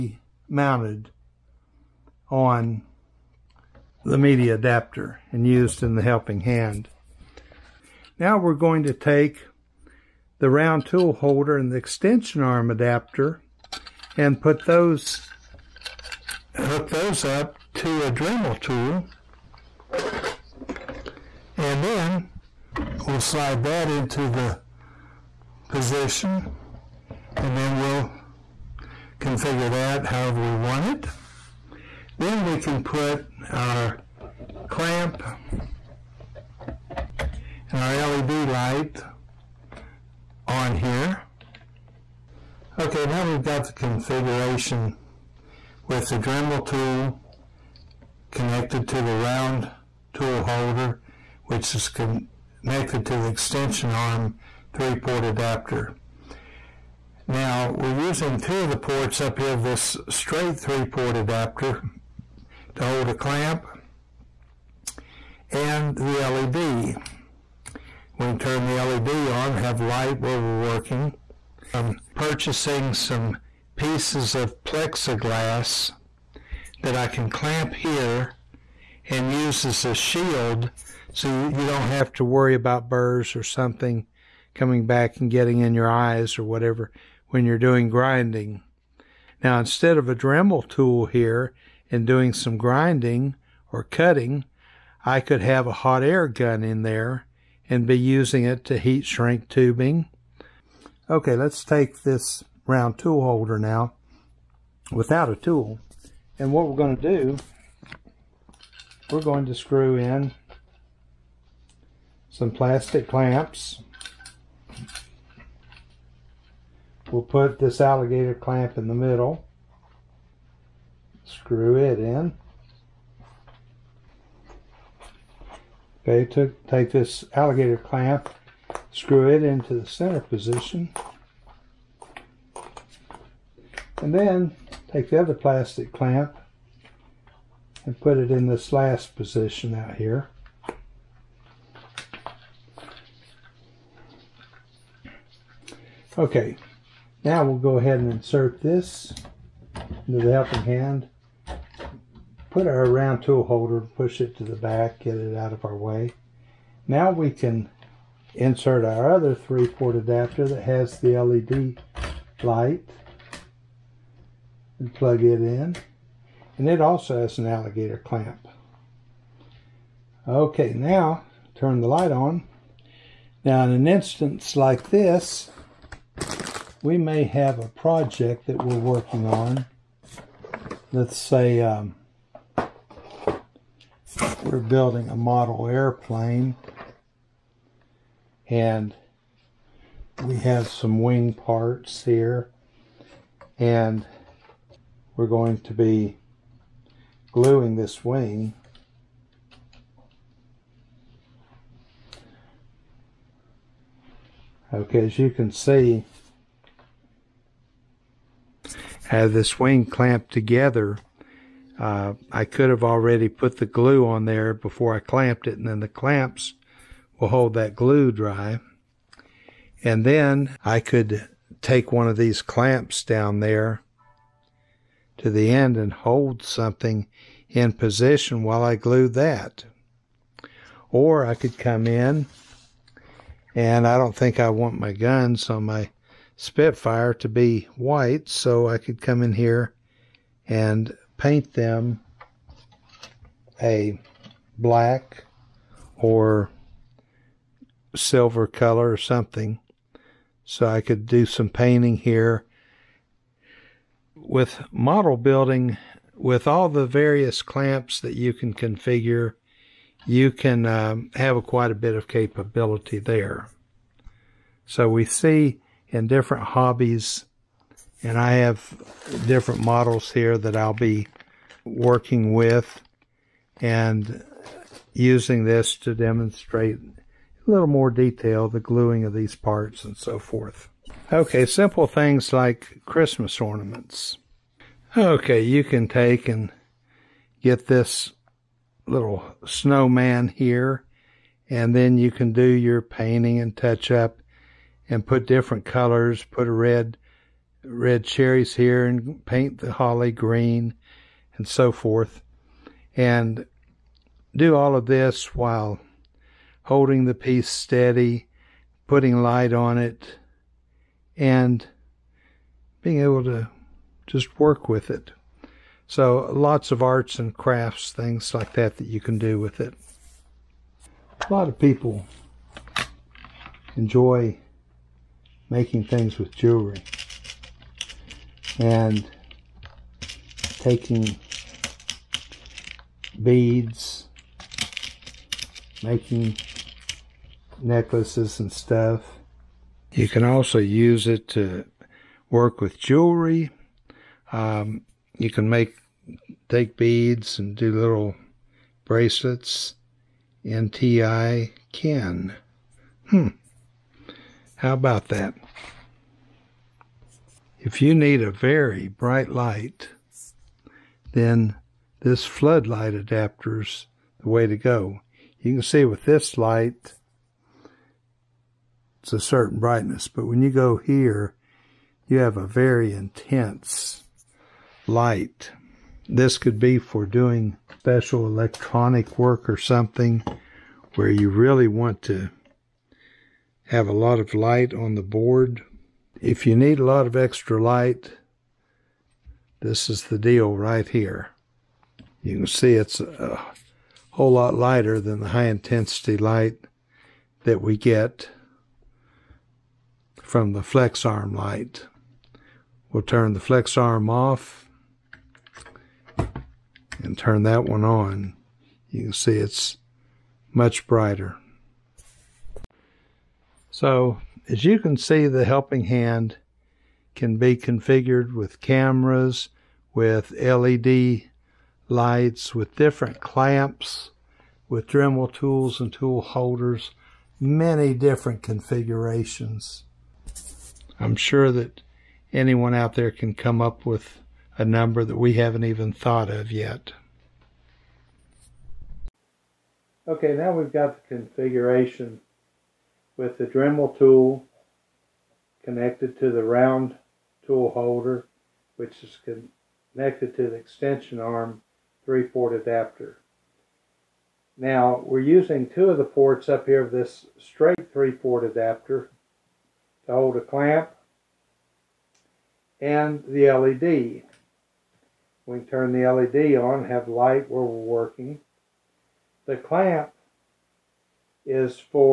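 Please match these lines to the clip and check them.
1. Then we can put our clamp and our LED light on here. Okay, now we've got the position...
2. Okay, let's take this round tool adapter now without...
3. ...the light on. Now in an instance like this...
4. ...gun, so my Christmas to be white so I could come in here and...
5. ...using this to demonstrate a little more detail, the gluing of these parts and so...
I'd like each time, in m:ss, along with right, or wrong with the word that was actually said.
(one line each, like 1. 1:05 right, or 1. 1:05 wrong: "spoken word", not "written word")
1. 0:32 wrong: "configuration", not "position"
2. 1:41 wrong: "holder", not "adapter"
3. 2:51 right
4. 3:54 wrong: "Spitfire", not "Christmas"
5. 4:34 right.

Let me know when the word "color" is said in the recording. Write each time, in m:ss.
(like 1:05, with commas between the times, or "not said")
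4:08, 4:55.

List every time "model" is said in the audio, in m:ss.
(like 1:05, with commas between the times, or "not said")
3:05, 4:14, 4:29.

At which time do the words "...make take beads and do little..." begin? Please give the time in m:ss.
5:45.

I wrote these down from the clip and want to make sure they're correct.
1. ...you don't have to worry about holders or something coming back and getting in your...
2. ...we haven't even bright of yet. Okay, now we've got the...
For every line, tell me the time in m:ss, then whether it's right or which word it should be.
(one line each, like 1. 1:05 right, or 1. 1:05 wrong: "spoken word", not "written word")
1. 1:21 wrong: "burrs", not "holders"
2. 7:15 wrong: "thought", not "bright".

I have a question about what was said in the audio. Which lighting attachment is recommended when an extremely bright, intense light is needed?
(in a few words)
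Floodlight adapter.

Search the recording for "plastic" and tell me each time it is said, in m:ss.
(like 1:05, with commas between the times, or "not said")
1:52, 2:15.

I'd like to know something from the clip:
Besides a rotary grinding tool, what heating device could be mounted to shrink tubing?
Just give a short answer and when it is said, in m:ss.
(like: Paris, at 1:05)
Hot air gun, at 1:35.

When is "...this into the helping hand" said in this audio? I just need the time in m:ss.
2:28.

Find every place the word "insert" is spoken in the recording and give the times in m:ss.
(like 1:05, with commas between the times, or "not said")
2:28, 2:38.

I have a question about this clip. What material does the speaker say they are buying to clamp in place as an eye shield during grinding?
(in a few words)
Plexiglass.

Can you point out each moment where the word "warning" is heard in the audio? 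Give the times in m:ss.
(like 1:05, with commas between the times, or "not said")
not said.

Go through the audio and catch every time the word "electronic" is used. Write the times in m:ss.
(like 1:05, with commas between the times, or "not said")
6:18.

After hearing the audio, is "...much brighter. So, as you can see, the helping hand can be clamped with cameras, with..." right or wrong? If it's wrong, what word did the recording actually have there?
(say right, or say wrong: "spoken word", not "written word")
wrong: "configured", not "clamped".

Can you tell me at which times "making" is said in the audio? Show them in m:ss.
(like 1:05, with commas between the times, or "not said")
5:25, 5:35.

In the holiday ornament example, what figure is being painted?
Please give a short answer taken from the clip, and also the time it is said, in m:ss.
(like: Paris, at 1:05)
Snowman, at 4:49.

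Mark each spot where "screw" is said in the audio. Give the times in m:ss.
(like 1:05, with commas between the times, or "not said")
1:49, 2:01, 2:08.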